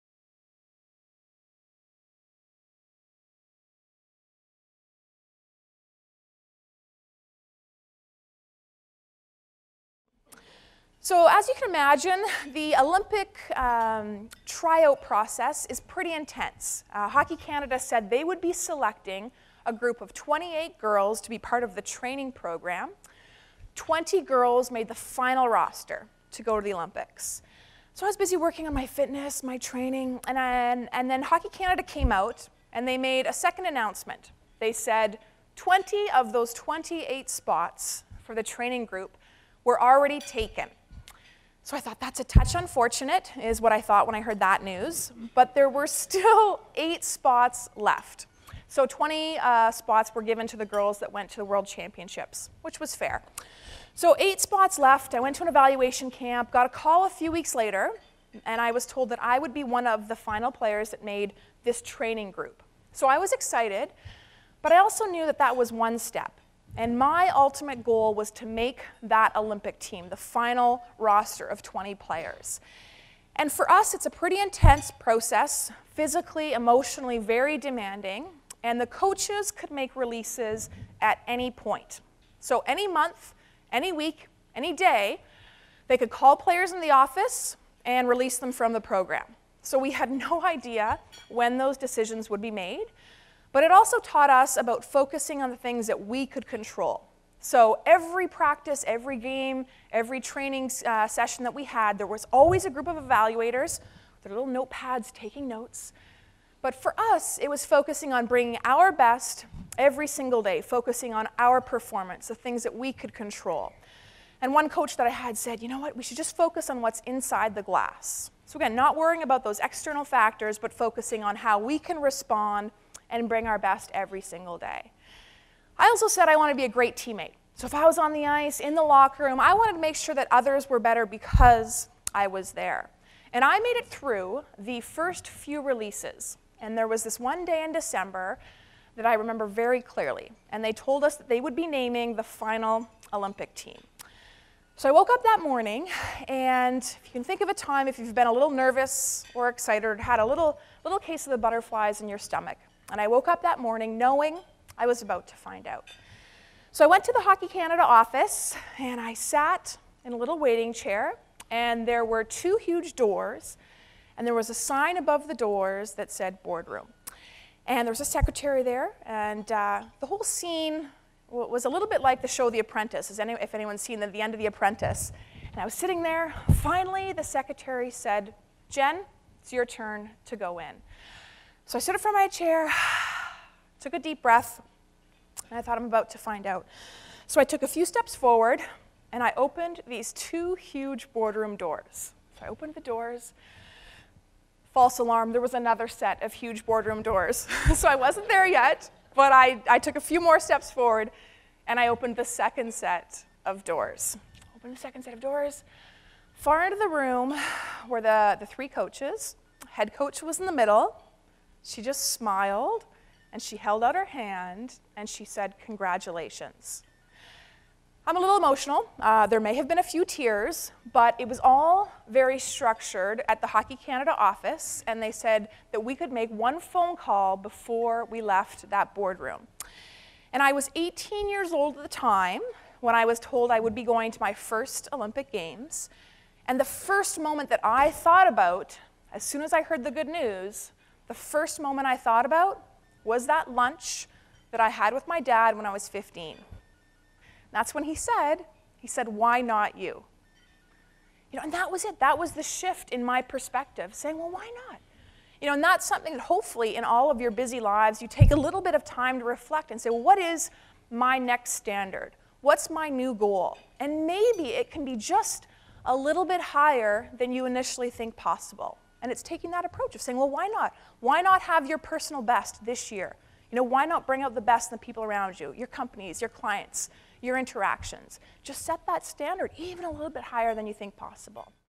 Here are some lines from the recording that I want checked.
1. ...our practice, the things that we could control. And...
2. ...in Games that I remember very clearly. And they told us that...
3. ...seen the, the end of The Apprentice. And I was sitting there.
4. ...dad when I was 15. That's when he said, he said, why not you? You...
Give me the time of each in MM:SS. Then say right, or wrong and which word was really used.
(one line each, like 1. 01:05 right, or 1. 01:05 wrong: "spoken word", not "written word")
1. 01:51 wrong: "performance", not "practice"
2. 02:17 wrong: "December", not "Games"
3. 02:53 right
4. 04:05 right.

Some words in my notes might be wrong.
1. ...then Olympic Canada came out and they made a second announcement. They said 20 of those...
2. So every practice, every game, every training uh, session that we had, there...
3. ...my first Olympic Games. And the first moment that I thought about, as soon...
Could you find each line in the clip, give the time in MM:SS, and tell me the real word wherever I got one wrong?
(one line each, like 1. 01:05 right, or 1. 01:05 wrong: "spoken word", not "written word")
1. 00:31 wrong: "Hockey", not "Olympic"
2. 01:37 right
3. 03:54 right.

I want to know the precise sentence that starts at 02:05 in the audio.
I also said I want to be a great teammate.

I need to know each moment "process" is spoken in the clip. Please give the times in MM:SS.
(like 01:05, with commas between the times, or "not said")
00:15, 01:14.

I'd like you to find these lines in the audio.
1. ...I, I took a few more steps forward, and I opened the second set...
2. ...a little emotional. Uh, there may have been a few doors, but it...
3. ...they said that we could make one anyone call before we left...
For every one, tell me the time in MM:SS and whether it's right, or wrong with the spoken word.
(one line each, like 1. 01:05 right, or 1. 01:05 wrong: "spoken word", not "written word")
1. 03:19 right
2. 03:38 wrong: "tears", not "doors"
3. 03:45 wrong: "phone", not "anyone".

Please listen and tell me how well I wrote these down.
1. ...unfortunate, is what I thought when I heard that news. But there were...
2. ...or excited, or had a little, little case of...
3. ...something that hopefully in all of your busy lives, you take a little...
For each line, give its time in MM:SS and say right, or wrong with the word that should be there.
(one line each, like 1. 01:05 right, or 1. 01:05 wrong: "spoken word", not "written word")
1. 00:42 right
2. 02:29 right
3. 04:15 right.